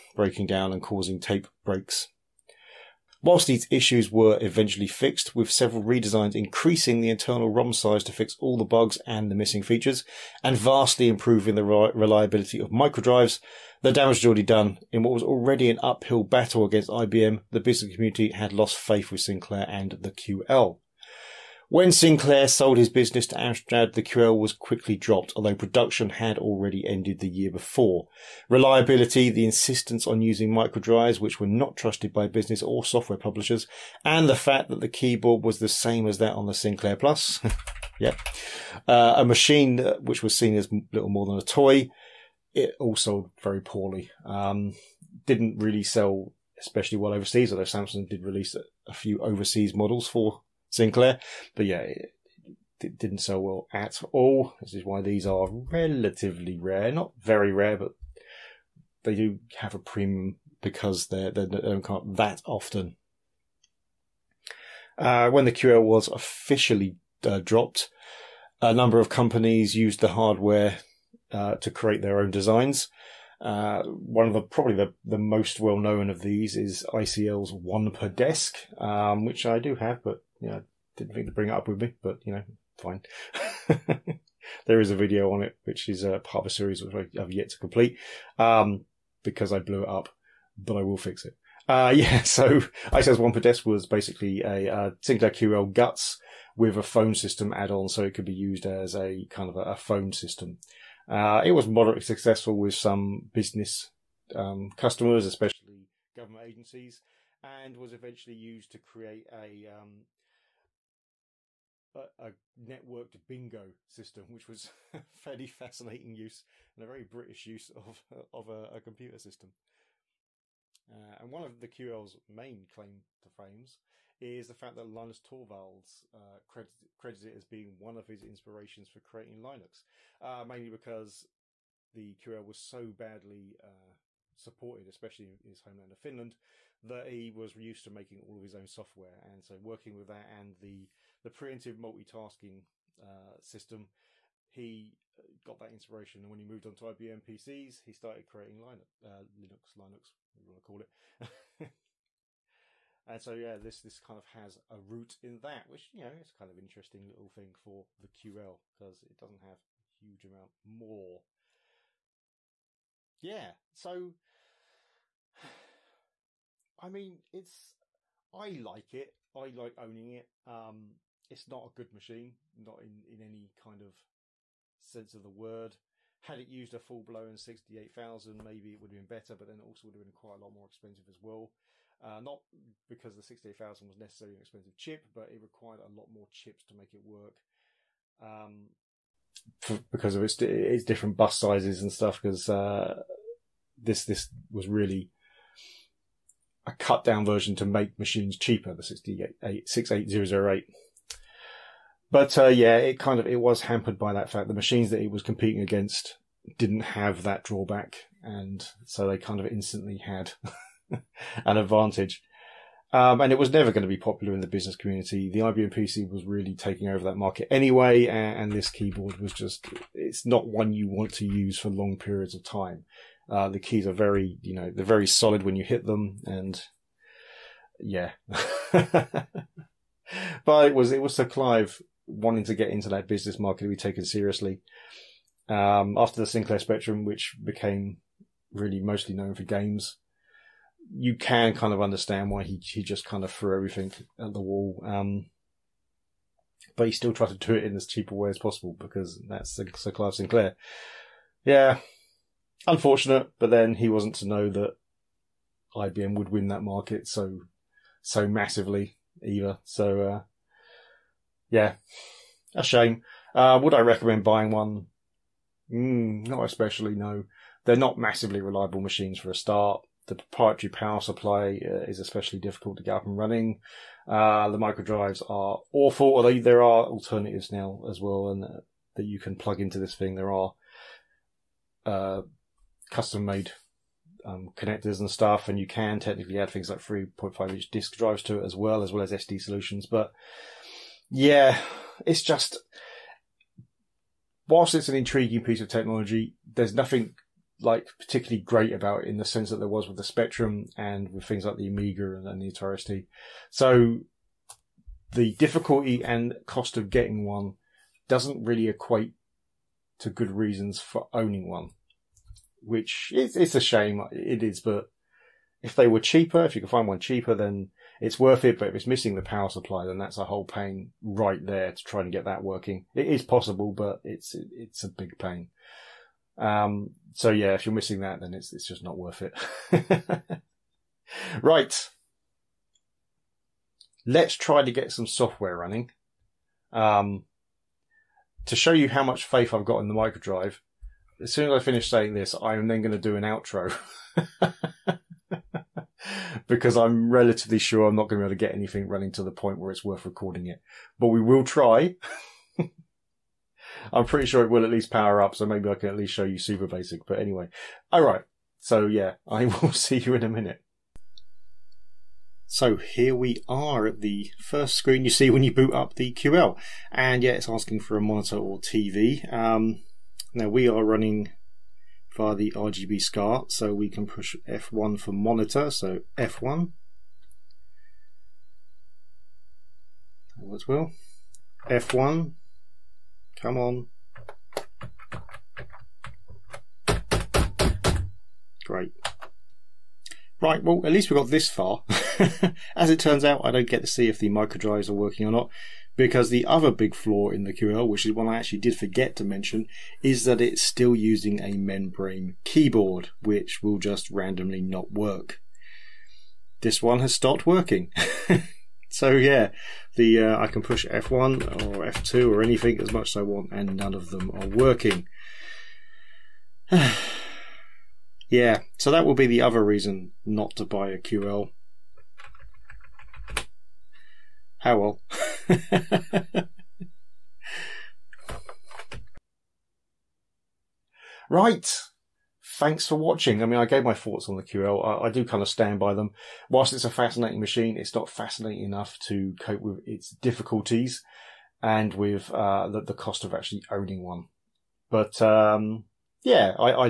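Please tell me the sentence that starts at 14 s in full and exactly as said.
In what was already an uphill battle against IBM, the business community had lost faith with Sinclair and the QL.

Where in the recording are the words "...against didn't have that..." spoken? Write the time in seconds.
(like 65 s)
205 s.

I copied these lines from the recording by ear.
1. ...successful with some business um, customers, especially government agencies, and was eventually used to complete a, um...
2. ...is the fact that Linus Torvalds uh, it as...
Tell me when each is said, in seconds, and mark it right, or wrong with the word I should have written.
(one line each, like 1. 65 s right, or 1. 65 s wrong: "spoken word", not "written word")
1. 102 s wrong: "create", not "complete"
2. 124 s right.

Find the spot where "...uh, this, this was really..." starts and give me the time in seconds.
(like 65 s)
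192 s.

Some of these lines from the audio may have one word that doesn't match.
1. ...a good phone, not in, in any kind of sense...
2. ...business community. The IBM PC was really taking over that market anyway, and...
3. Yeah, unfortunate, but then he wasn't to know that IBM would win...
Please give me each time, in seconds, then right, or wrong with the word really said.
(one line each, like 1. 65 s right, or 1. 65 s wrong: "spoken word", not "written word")
1. 171 s wrong: "machine", not "phone"
2. 214 s right
3. 251 s right.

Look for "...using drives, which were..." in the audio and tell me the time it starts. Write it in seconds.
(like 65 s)
30 s.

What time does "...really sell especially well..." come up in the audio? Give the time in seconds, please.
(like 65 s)
45 s.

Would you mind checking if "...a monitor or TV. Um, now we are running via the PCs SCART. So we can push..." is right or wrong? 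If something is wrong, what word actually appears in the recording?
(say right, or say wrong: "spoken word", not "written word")
wrong: "RGB", not "PCs".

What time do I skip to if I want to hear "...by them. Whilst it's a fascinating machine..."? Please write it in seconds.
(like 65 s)
435 s.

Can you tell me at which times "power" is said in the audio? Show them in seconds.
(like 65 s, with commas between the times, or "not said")
270 s, 319 s, 354 s.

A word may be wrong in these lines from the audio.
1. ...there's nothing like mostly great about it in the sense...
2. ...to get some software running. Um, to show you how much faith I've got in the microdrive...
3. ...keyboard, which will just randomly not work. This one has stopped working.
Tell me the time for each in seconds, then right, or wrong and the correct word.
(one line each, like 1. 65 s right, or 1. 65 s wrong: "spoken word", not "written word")
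1. 296 s wrong: "particularly", not "mostly"
2. 334 s right
3. 402 s right.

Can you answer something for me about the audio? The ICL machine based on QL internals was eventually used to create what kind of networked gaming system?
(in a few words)
bingo.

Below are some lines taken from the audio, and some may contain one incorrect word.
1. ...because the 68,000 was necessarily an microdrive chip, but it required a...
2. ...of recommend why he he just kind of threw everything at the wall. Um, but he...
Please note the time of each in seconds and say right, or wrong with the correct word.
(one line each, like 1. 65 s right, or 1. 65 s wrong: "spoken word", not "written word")
1. 182 s wrong: "expensive", not "microdrive"
2. 241 s wrong: "understand", not "recommend".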